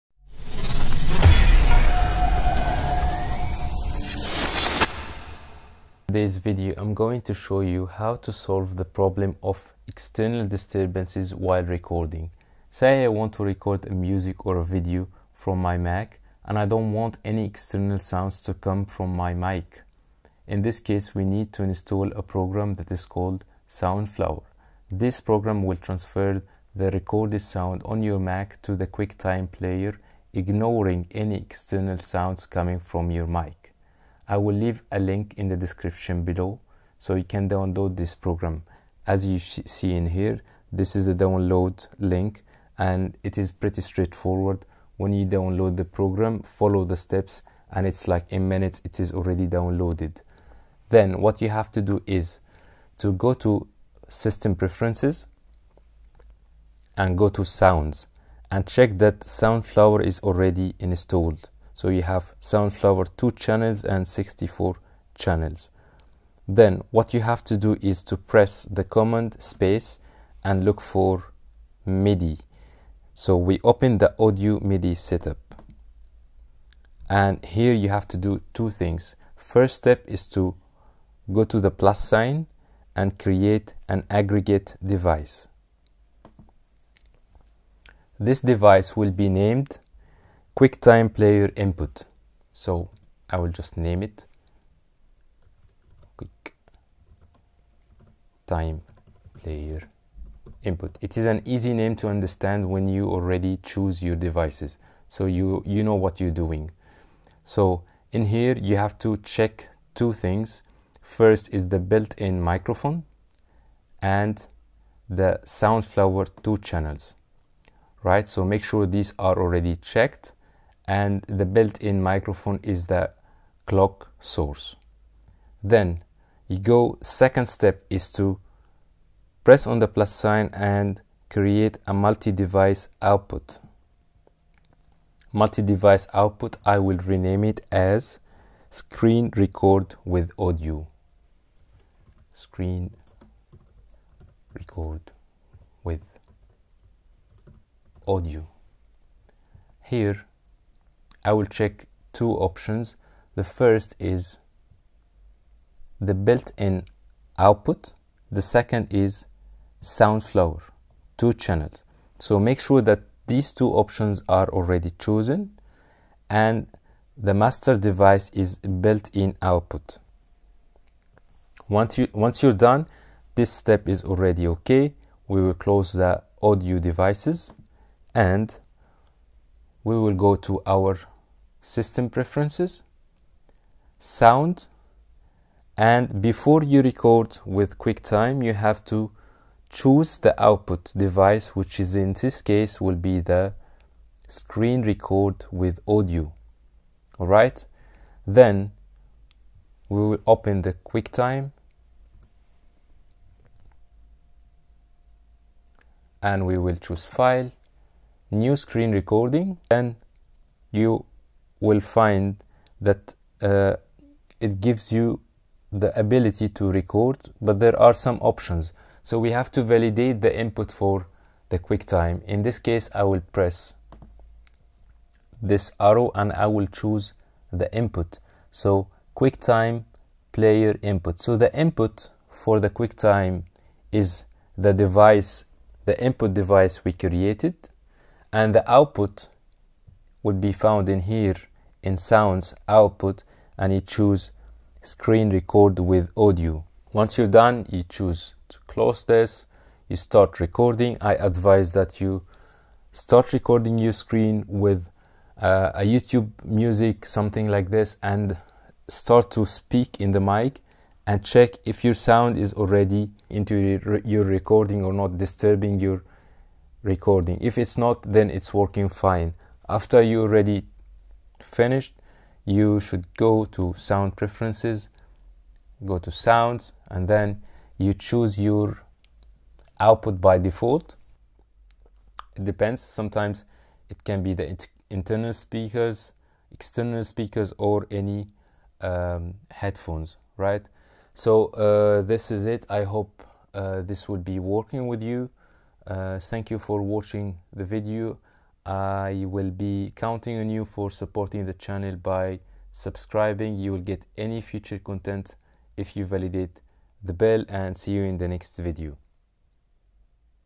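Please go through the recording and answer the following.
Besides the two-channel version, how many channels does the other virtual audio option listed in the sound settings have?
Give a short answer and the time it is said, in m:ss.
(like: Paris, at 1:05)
64, at 1:04.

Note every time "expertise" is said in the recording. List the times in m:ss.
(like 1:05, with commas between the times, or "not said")
not said.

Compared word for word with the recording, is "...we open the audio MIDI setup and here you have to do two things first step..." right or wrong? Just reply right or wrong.
right.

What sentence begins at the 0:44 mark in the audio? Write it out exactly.
When you download the program, follow the steps and it's like in minutes it is already downloaded.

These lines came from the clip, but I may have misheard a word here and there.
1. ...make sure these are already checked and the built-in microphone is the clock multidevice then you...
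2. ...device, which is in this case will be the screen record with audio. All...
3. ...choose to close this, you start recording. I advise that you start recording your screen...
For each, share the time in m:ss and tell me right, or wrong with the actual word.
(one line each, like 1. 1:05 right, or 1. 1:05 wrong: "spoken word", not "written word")
1. 1:58 wrong: "source", not "multidevice"
2. 3:10 right
3. 4:07 right.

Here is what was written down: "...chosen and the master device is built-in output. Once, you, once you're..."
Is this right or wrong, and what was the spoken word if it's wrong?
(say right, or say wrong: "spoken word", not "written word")
right.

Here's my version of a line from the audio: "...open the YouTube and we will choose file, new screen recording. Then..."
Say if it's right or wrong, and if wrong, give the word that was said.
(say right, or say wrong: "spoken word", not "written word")
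wrong: "QuickTime", not "YouTube".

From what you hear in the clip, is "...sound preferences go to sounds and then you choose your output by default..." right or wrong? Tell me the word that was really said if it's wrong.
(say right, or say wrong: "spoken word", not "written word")
right.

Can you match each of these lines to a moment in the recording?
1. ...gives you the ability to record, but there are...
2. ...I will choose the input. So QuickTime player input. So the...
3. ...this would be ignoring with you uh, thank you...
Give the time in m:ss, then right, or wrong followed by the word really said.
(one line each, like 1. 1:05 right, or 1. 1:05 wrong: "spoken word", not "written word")
1. 3:34 right
2. 3:46 right
3. 4:53 wrong: "working", not "ignoring".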